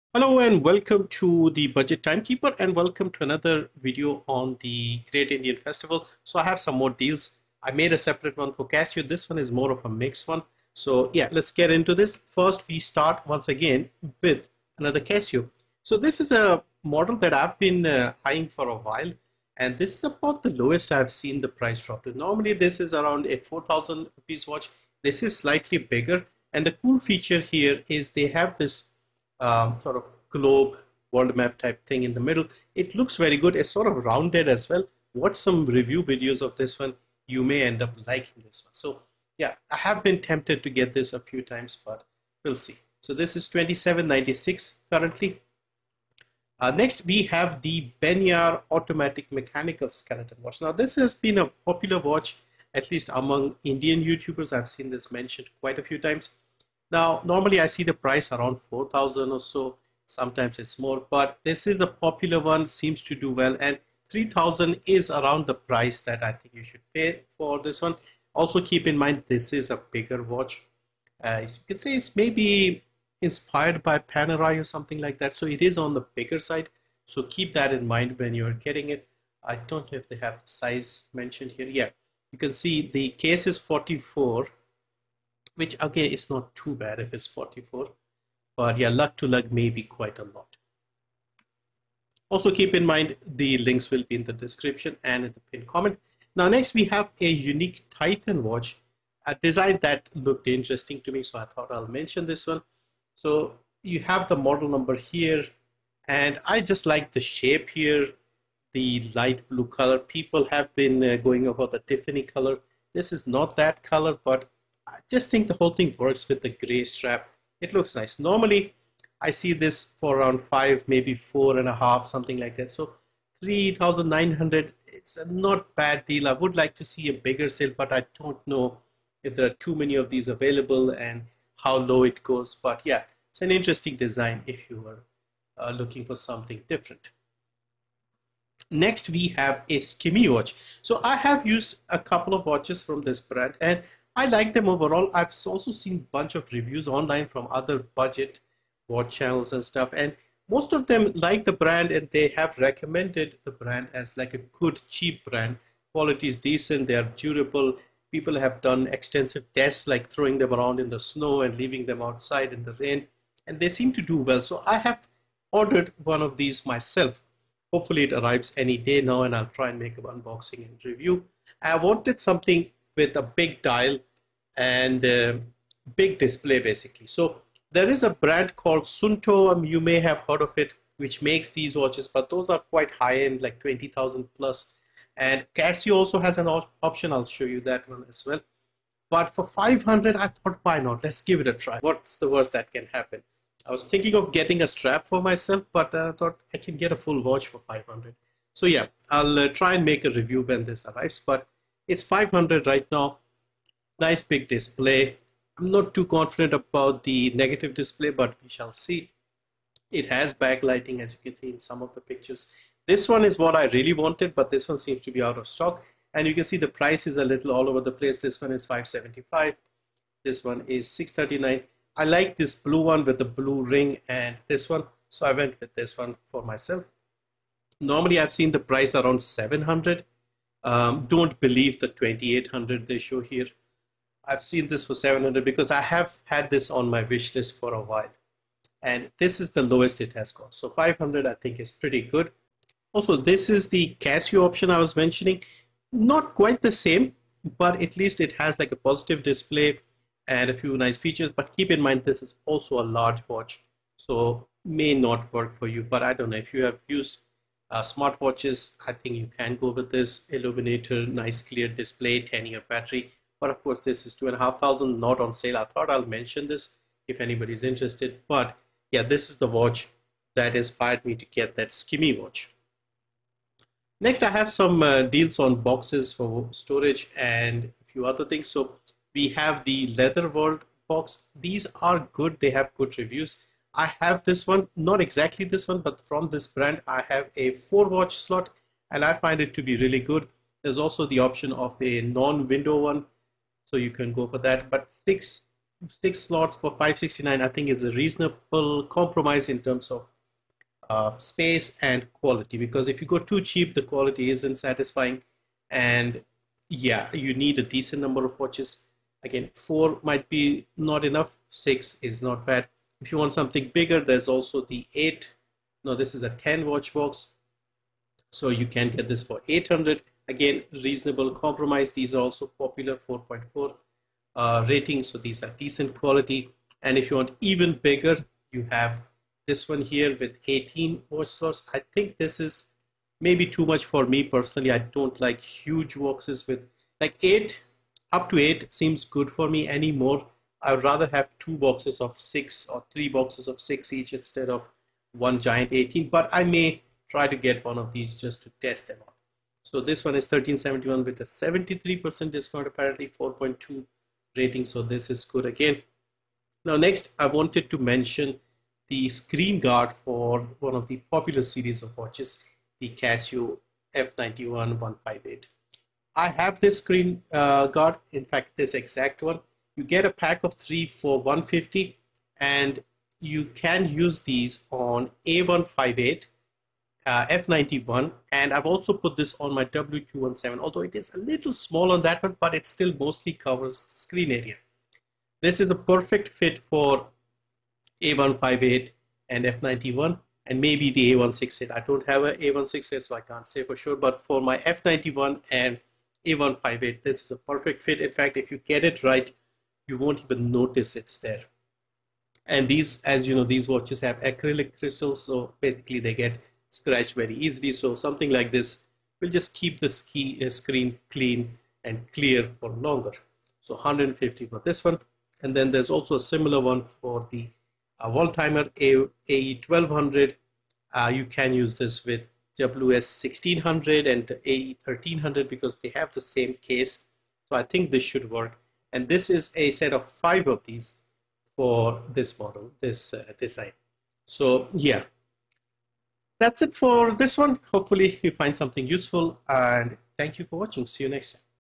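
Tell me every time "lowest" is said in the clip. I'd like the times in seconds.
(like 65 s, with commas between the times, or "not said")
20 s, 239 s.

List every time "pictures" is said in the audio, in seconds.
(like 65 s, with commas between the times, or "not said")
211 s.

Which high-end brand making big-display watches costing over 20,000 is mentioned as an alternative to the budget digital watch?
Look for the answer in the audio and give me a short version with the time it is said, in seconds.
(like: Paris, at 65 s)
Suunto, at 178 s.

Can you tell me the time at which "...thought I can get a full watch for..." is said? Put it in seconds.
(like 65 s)
196 s.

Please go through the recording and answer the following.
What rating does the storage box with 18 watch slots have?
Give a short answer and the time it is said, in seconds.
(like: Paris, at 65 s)
4.2, at 353 s.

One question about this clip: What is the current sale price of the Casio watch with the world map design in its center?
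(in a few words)
2796.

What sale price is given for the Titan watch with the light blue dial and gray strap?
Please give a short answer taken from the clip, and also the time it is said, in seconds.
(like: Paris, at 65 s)
3,900, at 123 s.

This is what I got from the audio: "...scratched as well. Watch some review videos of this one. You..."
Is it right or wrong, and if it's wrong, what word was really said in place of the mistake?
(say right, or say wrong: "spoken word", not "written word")
wrong: "rounded", not "scratched".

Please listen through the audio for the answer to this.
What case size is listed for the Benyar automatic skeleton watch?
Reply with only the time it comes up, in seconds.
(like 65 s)
82 s.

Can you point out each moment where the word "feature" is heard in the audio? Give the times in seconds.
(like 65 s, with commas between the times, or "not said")
26 s, 250 s.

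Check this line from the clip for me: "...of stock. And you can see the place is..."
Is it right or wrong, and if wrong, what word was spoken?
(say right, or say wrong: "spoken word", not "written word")
wrong: "price", not "place".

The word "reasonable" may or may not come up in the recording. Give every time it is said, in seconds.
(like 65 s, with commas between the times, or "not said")
297 s, 320 s.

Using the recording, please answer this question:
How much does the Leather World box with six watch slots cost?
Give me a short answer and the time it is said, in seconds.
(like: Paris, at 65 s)
569, at 296 s.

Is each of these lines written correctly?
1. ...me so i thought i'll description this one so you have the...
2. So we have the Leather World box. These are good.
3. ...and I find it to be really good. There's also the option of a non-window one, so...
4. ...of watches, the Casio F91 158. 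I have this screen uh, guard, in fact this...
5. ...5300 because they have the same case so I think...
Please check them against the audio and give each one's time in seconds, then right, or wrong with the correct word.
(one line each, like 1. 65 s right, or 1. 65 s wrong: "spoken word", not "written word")
1. 101 s wrong: "mention", not "description"
2. 278 s right
3. 288 s right
4. 361 s right
5. 424 s wrong: "1300", not "5300".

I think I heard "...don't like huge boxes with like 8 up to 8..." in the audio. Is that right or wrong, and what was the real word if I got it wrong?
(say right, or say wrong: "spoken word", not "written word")
right.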